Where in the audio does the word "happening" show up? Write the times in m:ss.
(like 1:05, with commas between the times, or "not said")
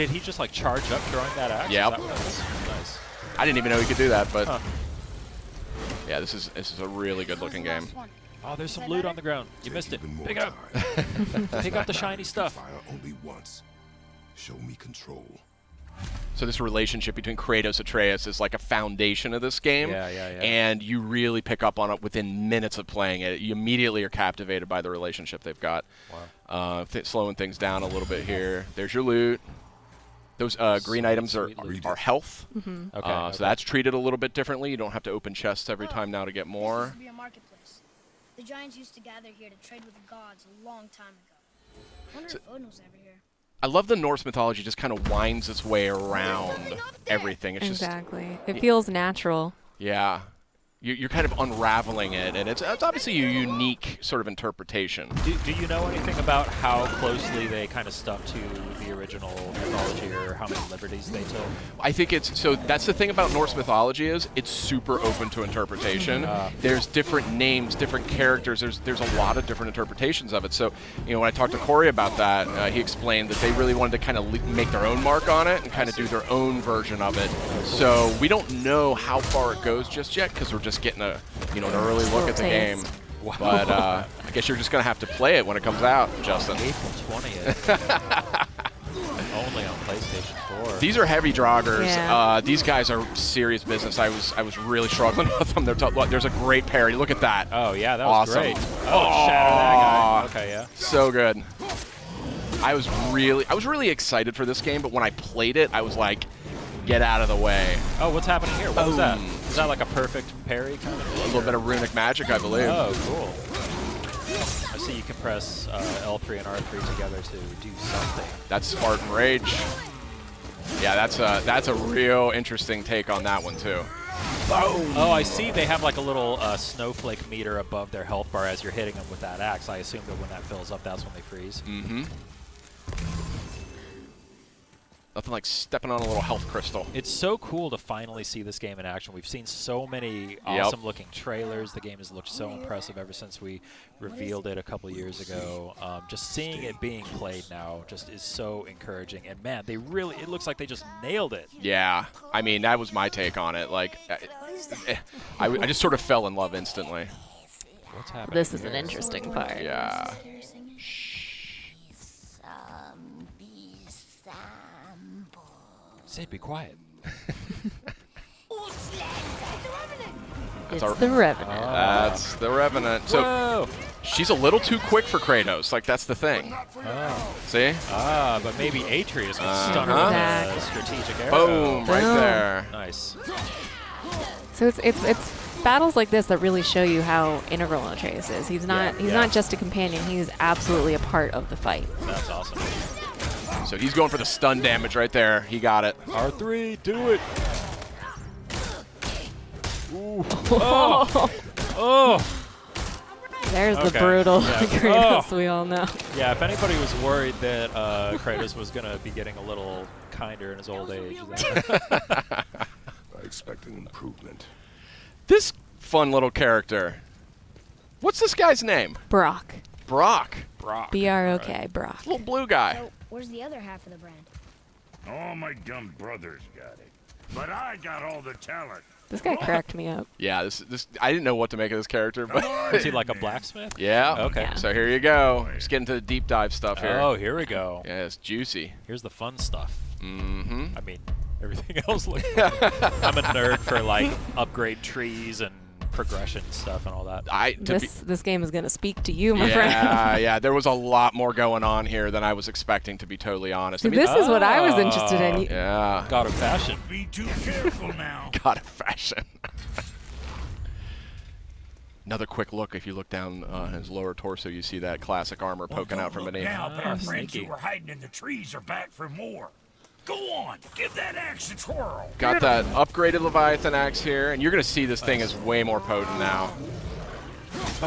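1:48, 2:38.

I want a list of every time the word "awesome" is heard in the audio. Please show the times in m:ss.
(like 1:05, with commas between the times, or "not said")
1:38, 2:20, 3:12.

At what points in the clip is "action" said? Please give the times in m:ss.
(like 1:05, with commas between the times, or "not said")
0:01, 2:18.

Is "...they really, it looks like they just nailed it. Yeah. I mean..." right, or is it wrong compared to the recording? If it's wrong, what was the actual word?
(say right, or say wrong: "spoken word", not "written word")
right.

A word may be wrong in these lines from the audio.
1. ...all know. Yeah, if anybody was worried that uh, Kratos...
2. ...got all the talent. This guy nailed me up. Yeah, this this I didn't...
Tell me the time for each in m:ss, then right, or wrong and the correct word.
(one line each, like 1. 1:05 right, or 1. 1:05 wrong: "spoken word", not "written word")
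1. 3:25 right
2. 3:47 wrong: "cracked", not "nailed".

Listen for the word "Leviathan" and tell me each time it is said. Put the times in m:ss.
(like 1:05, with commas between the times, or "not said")
4:33.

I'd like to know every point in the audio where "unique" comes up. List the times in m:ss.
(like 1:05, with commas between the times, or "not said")
0:53.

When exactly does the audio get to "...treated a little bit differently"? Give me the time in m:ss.
0:33.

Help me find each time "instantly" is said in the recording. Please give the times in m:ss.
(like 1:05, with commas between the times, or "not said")
2:36.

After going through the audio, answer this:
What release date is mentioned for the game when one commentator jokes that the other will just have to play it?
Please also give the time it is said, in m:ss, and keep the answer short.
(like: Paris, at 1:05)
April 20th, at 1:26.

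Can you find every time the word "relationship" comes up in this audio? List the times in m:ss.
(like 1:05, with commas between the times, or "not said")
0:16, 0:24.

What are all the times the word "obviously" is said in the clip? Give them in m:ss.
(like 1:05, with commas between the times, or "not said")
0:52.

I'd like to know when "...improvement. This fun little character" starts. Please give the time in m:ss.
3:33.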